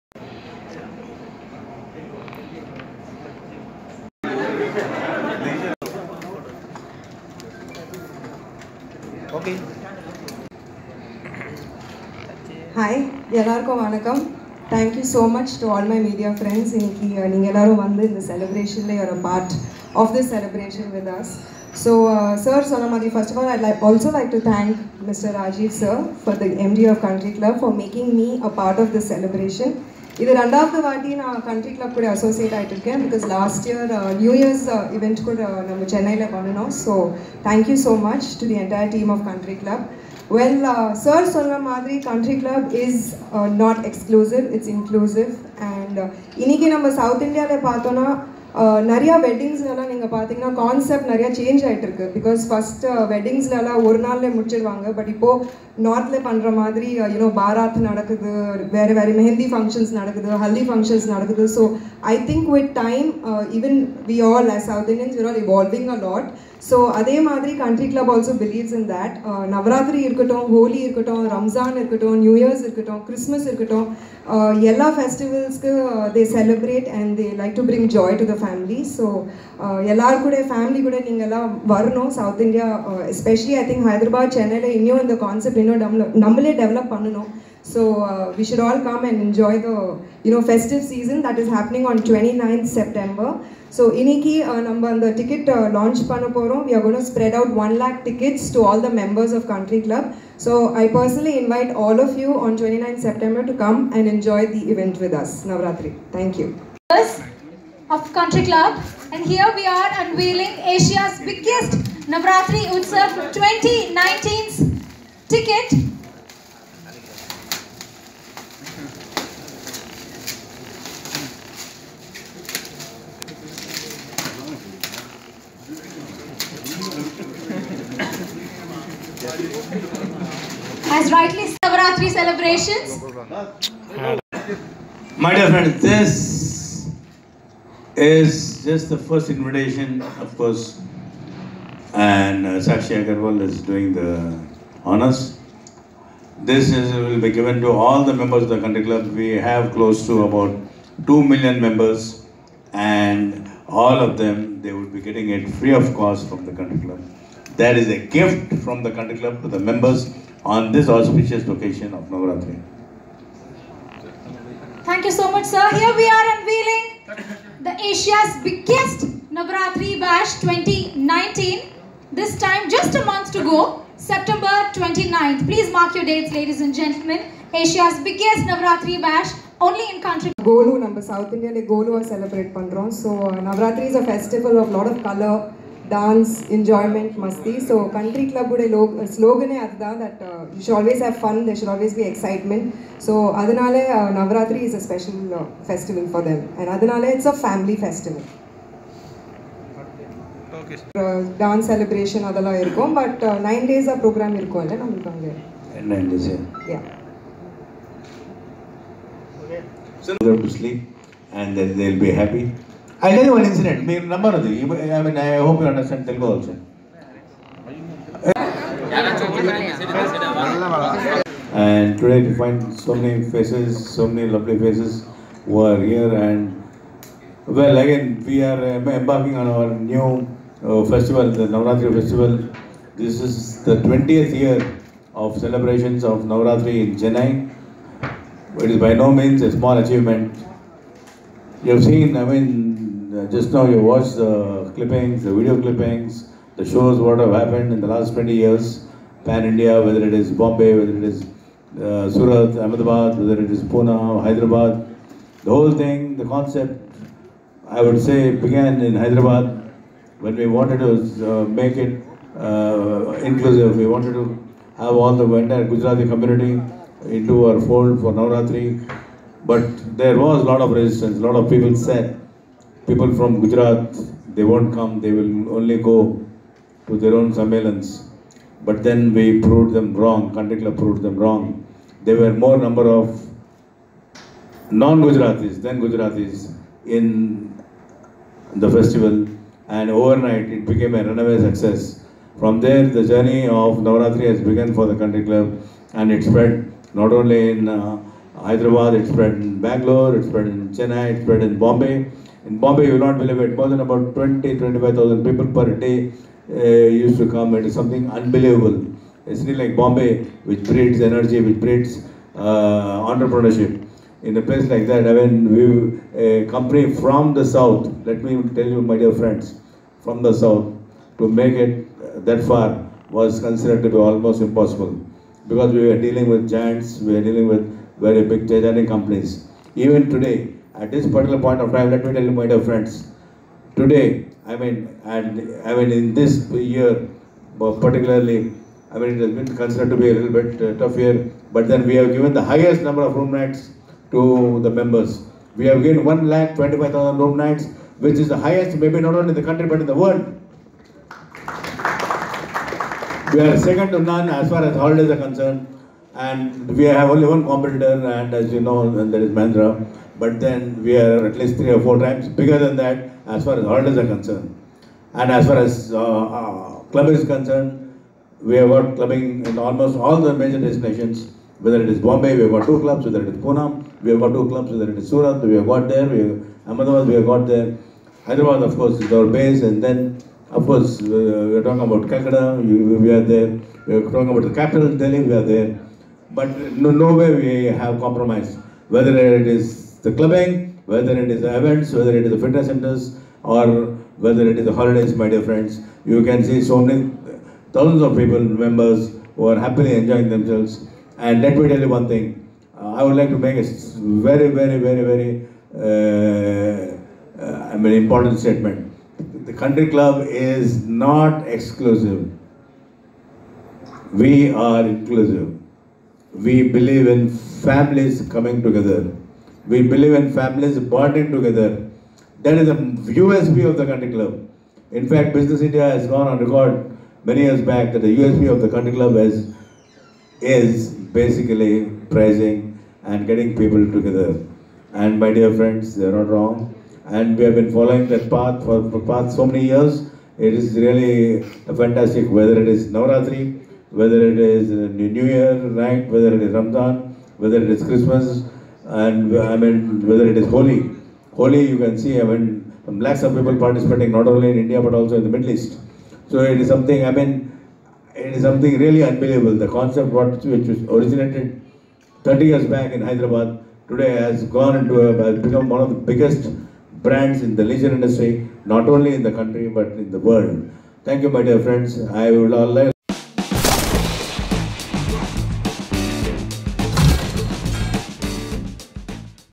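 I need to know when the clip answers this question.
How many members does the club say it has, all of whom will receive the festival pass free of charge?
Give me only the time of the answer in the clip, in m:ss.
2:31.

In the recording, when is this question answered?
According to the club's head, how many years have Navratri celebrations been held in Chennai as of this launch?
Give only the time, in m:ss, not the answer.
3:53.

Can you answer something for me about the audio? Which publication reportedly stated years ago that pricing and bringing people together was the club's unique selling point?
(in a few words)
Business India.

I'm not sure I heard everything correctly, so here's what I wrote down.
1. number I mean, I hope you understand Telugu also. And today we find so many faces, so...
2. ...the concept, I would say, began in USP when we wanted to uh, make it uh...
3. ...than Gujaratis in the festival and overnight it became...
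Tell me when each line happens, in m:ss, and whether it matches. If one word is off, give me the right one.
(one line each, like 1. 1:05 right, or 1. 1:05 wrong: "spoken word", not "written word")
1. 3:34 right
2. 4:16 wrong: "Hyderabad", not "USP"
3. 4:45 right.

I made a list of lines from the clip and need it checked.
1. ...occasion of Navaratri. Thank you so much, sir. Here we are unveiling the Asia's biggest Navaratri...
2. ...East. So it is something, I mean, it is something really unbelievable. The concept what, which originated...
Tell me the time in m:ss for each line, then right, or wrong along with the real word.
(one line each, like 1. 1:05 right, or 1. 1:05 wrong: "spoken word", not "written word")
1. 2:41 right
2. 7:35 right.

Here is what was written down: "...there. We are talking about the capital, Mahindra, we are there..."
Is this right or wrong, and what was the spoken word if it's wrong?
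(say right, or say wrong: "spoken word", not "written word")
wrong: "Delhi", not "Mahindra".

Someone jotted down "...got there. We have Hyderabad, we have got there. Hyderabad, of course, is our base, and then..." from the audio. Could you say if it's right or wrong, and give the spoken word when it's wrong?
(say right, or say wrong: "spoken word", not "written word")
wrong: "Ahmedabad", not "Hyderabad".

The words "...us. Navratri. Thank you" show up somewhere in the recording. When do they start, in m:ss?
1:45.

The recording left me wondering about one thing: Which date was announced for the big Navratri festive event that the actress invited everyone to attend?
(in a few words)
29th September.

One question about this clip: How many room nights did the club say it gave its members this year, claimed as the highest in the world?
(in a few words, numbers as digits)
1,25,000.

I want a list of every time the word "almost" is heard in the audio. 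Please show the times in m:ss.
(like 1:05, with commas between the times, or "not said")
5:23, 6:09.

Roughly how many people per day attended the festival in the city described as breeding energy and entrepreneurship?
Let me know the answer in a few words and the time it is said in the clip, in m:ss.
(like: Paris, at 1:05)
20-25,000, at 5:04.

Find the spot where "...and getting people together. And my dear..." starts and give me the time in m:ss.
7:13.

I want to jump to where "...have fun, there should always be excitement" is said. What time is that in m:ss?
3:11.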